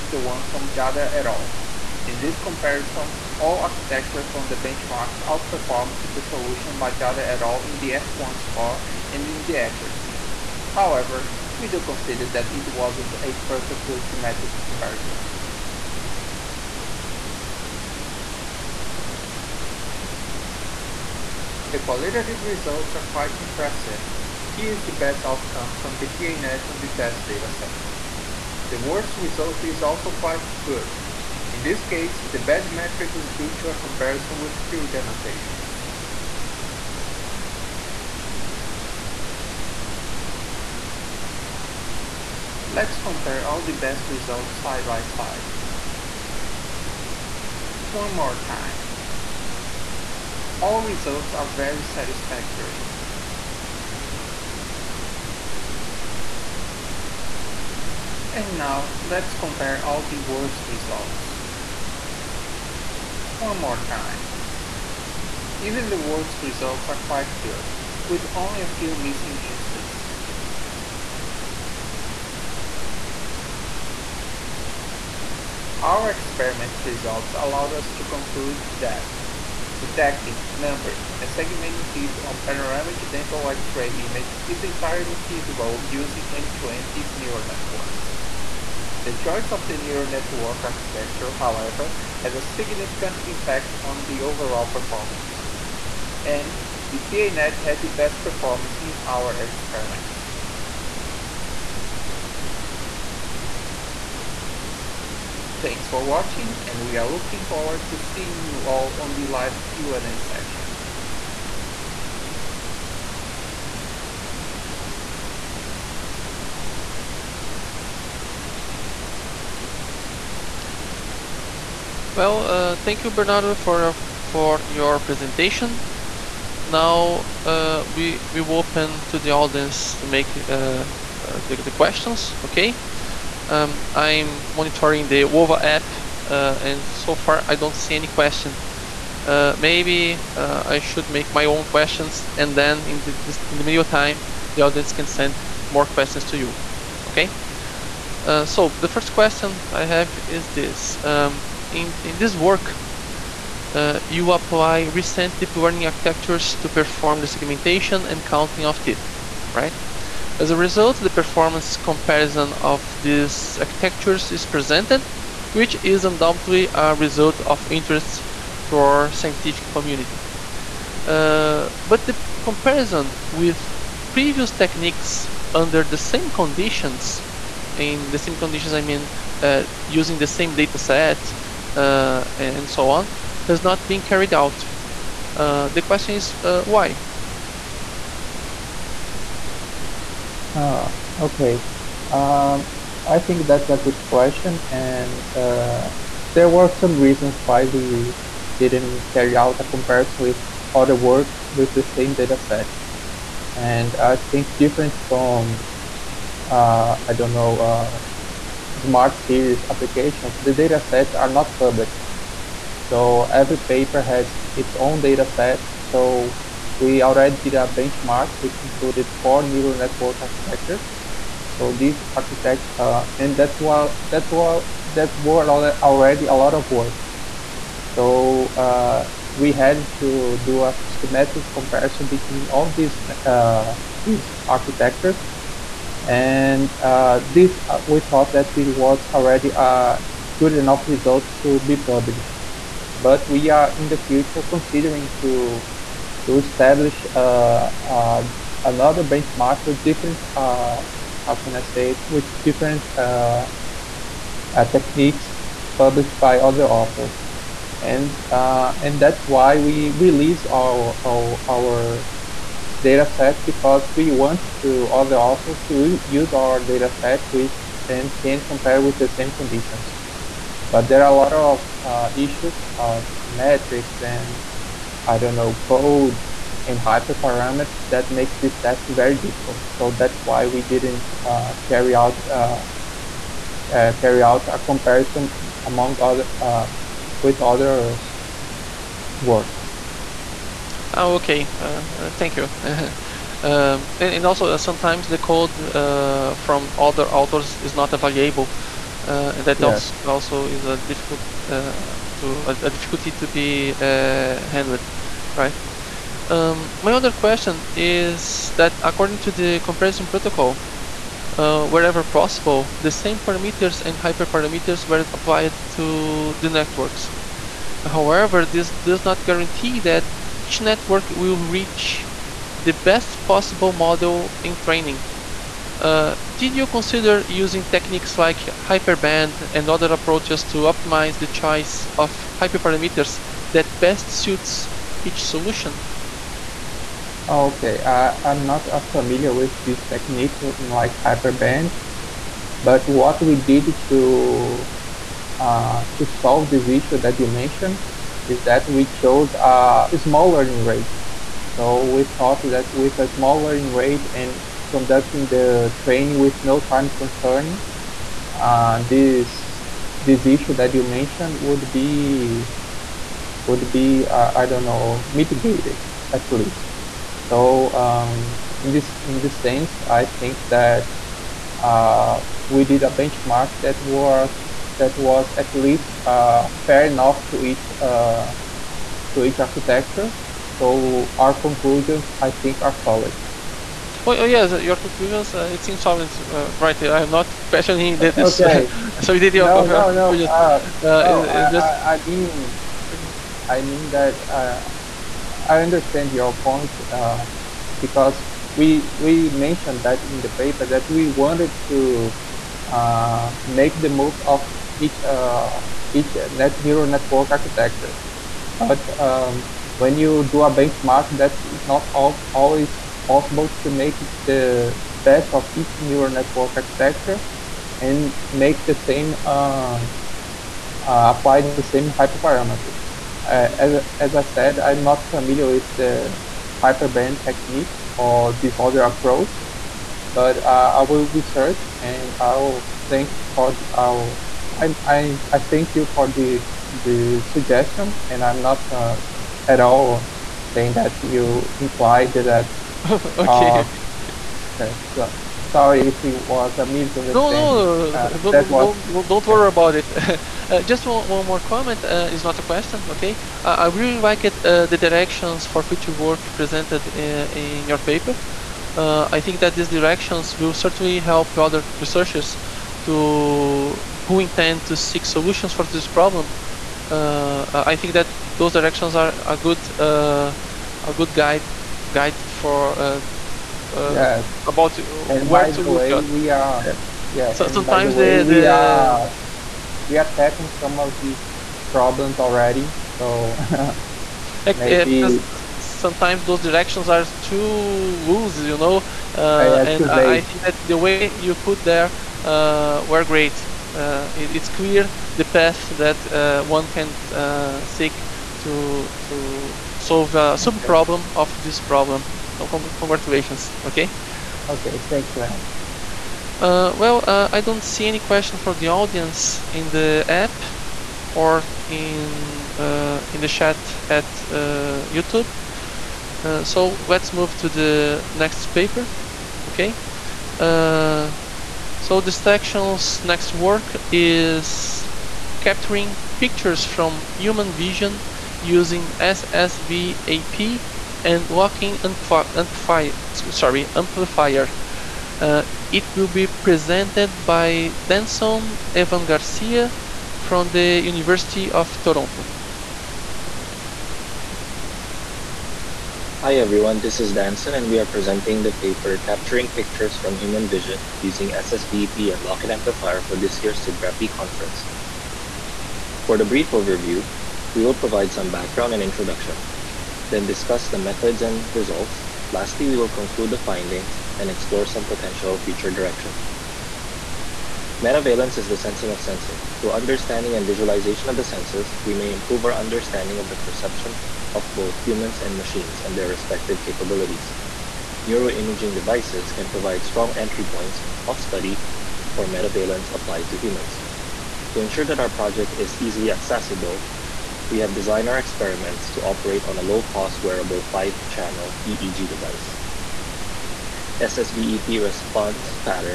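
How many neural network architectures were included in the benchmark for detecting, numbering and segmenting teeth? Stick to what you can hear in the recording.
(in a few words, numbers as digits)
4.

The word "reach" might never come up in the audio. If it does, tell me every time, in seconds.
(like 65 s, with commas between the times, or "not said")
321 s.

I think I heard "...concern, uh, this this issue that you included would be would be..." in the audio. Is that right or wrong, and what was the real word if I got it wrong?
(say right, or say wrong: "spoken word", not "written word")
wrong: "mentioned", not "included".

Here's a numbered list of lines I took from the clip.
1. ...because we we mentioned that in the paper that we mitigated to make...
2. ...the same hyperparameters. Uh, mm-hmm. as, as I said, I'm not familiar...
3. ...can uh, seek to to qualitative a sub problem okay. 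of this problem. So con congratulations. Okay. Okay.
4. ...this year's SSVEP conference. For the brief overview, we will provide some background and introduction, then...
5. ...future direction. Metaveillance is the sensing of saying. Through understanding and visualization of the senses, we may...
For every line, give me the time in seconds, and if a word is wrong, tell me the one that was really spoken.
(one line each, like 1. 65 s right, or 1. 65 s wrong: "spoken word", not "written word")
1. 397 s wrong: "wanted", not "mitigated"
2. 421 s right
3. 496 s wrong: "solve", not "qualitative"
4. 553 s wrong: "SIBGRAPI", not "SSVEP"
5. 565 s wrong: "sensing", not "saying".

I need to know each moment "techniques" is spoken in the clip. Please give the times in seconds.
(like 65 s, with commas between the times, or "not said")
174 s, 254 s, 327 s, 339 s, 427 s.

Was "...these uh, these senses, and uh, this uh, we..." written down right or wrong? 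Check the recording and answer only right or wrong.
wrong.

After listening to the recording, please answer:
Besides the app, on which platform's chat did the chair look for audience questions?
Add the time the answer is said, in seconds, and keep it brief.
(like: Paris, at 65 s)
YouTube, at 514 s.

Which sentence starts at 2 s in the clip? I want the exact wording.
In this comparison, all architectures from the benchmark outperformed the solution by Jader et al.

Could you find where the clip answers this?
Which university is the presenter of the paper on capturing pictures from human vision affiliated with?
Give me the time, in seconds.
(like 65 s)
540 s.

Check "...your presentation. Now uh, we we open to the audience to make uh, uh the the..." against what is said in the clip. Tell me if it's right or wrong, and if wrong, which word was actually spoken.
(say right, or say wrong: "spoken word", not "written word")
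right.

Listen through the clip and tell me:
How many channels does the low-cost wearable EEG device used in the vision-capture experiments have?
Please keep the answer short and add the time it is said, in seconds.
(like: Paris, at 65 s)
5, at 590 s.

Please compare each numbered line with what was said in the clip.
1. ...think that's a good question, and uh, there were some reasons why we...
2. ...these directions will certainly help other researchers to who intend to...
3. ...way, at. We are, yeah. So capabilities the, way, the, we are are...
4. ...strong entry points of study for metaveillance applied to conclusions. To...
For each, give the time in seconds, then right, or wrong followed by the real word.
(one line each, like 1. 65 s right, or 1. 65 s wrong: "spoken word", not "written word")
1. 193 s right
2. 459 s right
3. 475 s wrong: "sometimes", not "capabilities"
4. 579 s wrong: "humans", not "conclusions".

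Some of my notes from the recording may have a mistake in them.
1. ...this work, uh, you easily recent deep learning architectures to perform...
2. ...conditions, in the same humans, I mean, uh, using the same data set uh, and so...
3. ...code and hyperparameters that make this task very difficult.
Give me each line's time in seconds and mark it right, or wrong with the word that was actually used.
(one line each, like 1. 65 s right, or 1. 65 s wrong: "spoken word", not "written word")
1. 152 s wrong: "apply", not "easily"
2. 176 s wrong: "conditions", not "humans"
3. 275 s right.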